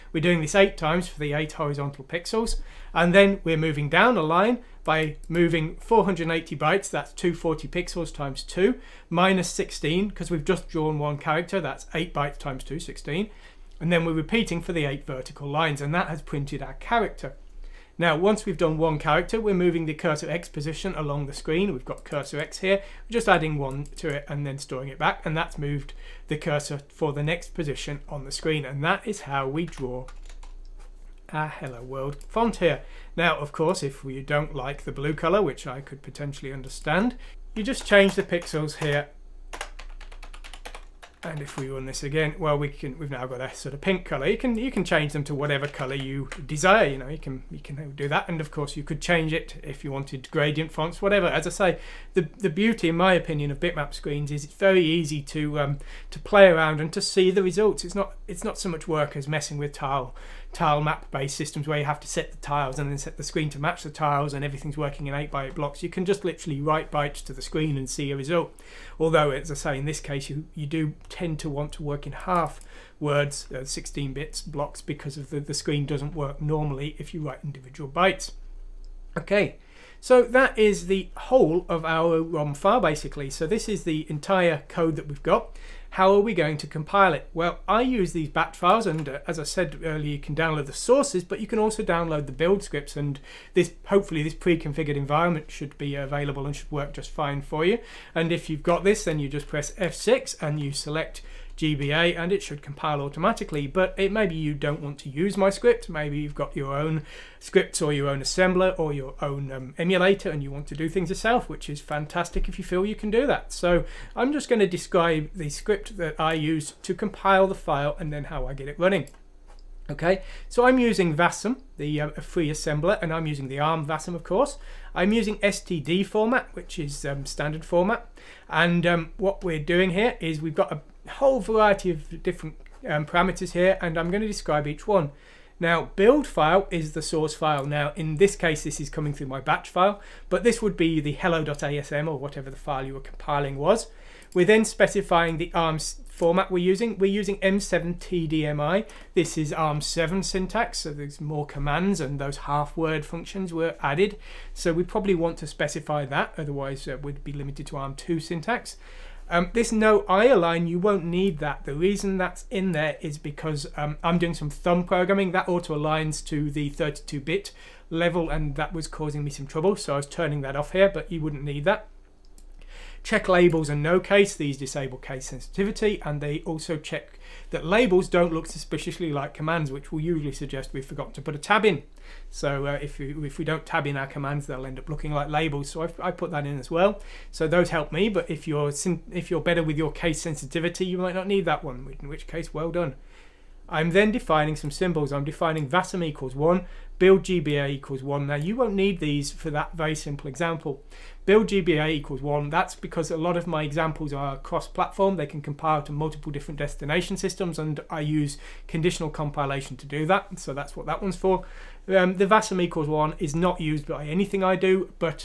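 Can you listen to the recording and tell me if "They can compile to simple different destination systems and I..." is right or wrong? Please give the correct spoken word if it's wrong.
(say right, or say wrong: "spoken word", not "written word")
wrong: "multiple", not "simple".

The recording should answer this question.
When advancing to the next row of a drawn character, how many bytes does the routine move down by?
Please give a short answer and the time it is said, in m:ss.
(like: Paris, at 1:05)
480, at 0:05.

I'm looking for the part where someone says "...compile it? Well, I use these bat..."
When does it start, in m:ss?
1:26.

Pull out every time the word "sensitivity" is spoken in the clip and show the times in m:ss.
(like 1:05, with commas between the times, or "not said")
2:55, 3:10.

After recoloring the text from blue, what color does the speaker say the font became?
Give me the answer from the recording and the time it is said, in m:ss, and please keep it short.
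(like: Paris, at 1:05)
pink, at 0:43.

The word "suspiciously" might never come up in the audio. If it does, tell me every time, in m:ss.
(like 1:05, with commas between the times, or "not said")
2:58.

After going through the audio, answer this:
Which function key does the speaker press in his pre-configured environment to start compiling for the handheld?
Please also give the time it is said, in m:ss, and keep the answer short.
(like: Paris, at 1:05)
F6, at 1:39.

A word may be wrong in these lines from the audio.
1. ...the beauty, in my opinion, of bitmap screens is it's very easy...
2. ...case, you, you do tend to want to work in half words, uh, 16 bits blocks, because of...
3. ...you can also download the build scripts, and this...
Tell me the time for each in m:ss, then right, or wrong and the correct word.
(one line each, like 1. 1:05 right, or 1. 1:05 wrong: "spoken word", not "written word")
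1. 0:52 right
2. 1:09 right
3. 1:31 right.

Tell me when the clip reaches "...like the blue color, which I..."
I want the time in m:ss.
0:34.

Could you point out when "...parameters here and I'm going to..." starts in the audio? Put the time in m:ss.
2:13.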